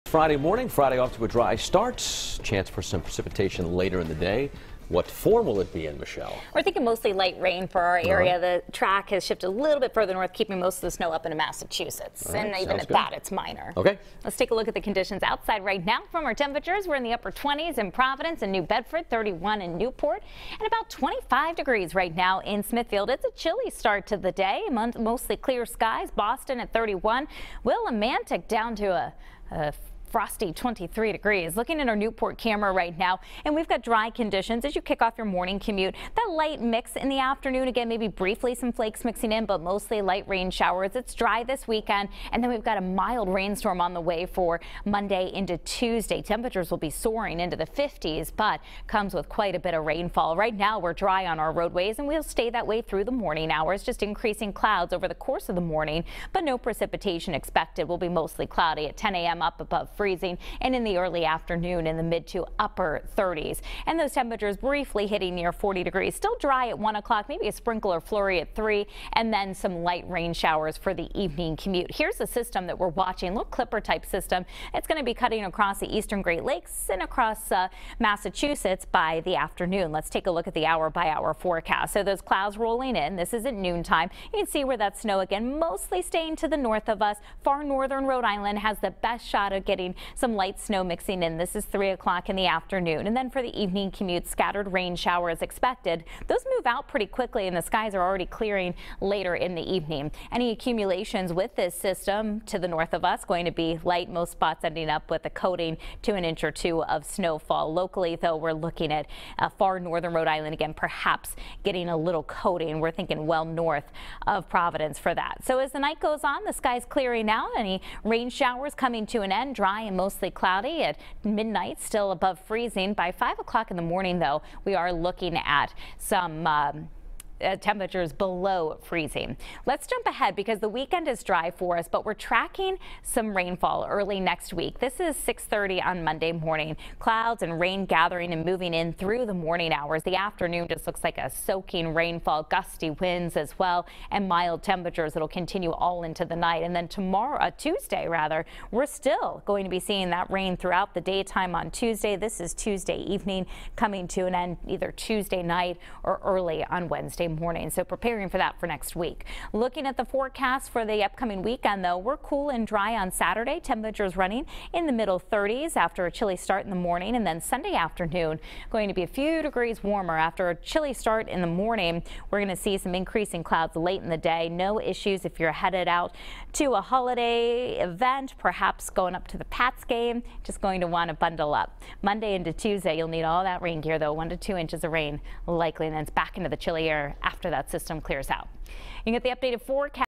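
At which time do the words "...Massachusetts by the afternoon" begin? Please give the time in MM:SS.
01:17.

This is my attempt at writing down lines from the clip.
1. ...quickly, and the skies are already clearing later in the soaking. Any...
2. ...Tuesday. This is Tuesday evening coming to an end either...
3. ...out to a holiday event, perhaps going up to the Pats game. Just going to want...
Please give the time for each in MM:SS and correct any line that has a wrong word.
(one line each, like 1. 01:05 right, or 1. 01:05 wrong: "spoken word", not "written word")
1. 01:37 wrong: "evening", not "soaking"
2. 02:31 right
3. 02:55 right.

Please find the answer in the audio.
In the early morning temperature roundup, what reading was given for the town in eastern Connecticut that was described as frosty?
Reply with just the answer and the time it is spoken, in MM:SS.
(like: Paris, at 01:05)
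23 degrees, at 00:30.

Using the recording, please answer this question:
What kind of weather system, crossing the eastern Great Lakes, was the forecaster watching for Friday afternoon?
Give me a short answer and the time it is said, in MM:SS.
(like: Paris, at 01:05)
clipper, at 01:13.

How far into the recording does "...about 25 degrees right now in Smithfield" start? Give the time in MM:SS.
00:20.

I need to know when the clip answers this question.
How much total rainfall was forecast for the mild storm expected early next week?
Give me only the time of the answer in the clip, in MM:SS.
03:04.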